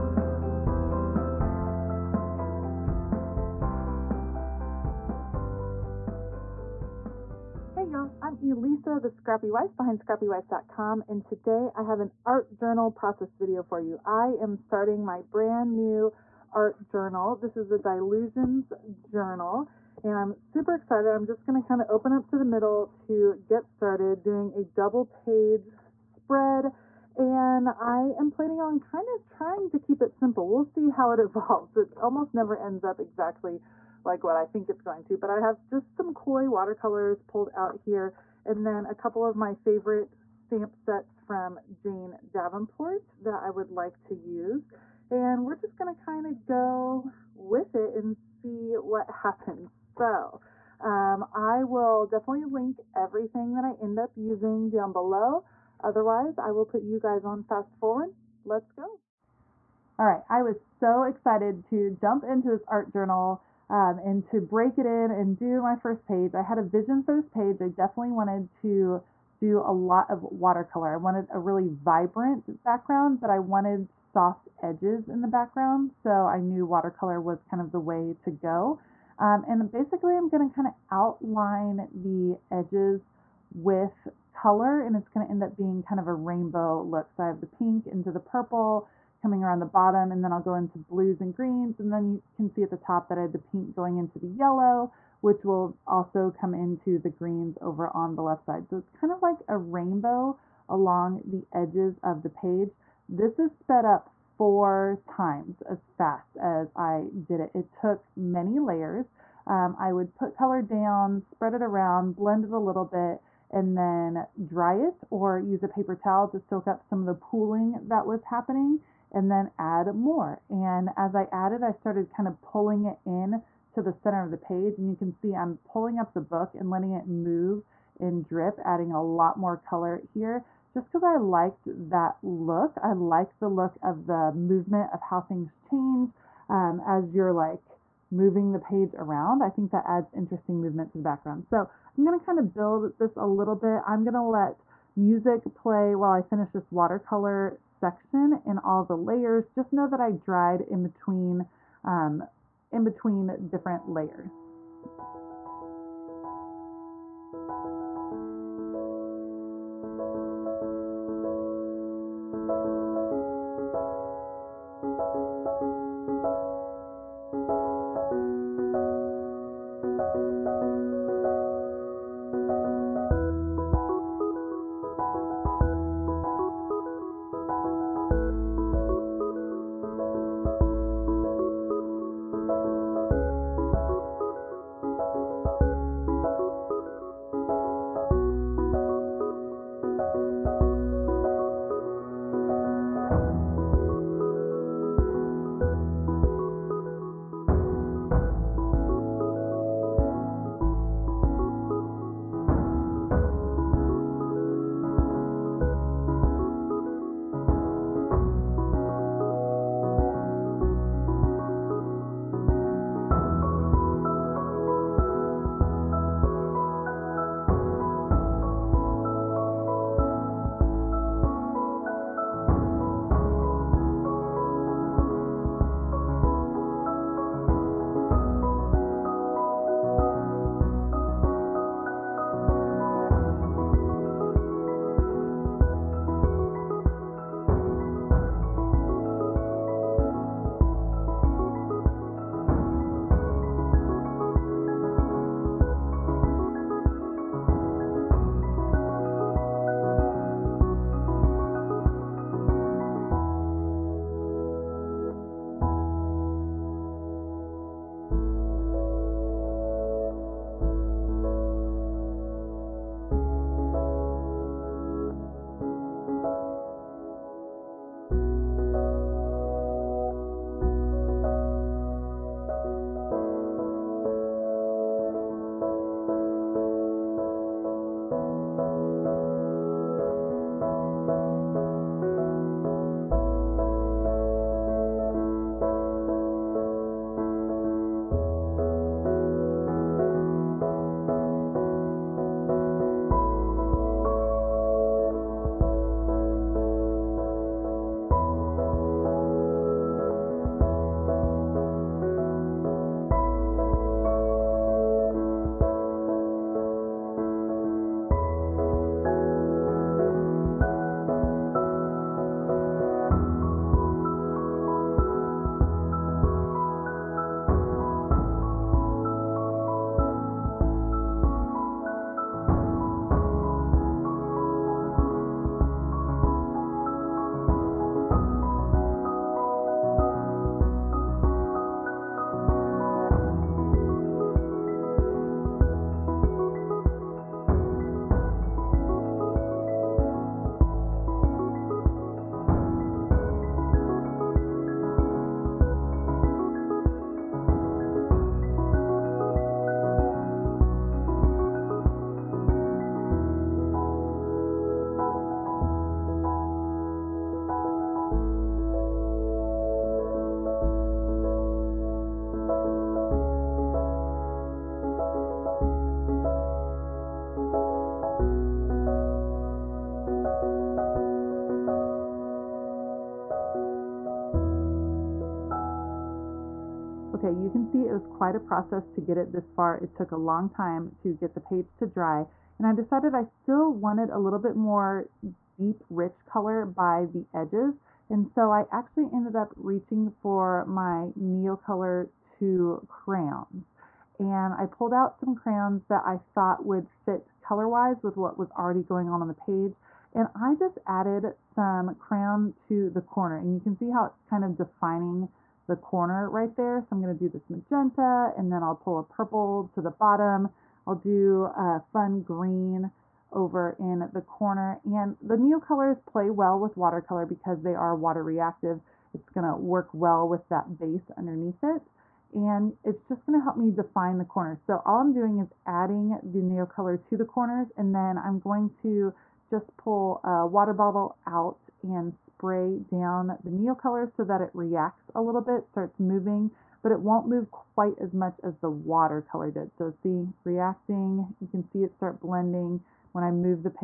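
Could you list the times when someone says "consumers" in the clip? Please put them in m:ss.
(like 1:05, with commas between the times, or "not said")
not said.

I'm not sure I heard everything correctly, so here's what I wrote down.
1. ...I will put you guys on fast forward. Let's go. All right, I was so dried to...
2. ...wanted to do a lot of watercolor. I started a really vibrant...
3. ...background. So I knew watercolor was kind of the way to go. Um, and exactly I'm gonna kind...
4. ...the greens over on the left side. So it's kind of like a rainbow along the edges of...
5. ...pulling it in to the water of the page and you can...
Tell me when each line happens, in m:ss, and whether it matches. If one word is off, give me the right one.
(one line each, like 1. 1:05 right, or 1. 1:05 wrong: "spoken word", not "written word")
1. 0:56 wrong: "excited", not "dried"
2. 1:08 wrong: "wanted", not "started"
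3. 1:15 wrong: "basically", not "exactly"
4. 1:36 right
5. 2:02 wrong: "center", not "water".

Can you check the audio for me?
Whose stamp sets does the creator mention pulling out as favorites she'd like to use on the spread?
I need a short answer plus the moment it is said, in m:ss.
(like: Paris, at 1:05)
Jane Davenport, at 0:41.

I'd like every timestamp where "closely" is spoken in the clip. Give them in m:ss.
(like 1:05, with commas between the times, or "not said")
not said.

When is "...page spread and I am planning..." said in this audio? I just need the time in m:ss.
0:25.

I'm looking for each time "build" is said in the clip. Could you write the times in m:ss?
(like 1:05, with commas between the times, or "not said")
2:22.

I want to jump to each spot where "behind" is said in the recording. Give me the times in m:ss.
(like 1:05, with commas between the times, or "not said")
0:09.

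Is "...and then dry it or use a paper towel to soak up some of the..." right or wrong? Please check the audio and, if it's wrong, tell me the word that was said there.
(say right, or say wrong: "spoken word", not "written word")
right.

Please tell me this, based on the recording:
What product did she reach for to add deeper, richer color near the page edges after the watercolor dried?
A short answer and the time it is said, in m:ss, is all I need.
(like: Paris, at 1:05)
Neocolor 2 crayons, at 6:31.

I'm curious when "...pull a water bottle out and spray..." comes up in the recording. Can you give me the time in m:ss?
7:09.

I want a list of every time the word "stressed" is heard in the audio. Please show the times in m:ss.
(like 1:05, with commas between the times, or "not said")
not said.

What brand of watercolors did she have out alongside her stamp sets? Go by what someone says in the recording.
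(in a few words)
koi.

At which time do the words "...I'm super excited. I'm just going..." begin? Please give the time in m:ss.
0:20.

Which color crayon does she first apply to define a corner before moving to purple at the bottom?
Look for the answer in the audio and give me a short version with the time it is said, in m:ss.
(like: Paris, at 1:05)
magenta, at 6:47.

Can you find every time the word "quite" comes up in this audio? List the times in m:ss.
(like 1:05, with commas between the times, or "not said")
6:18, 7:17.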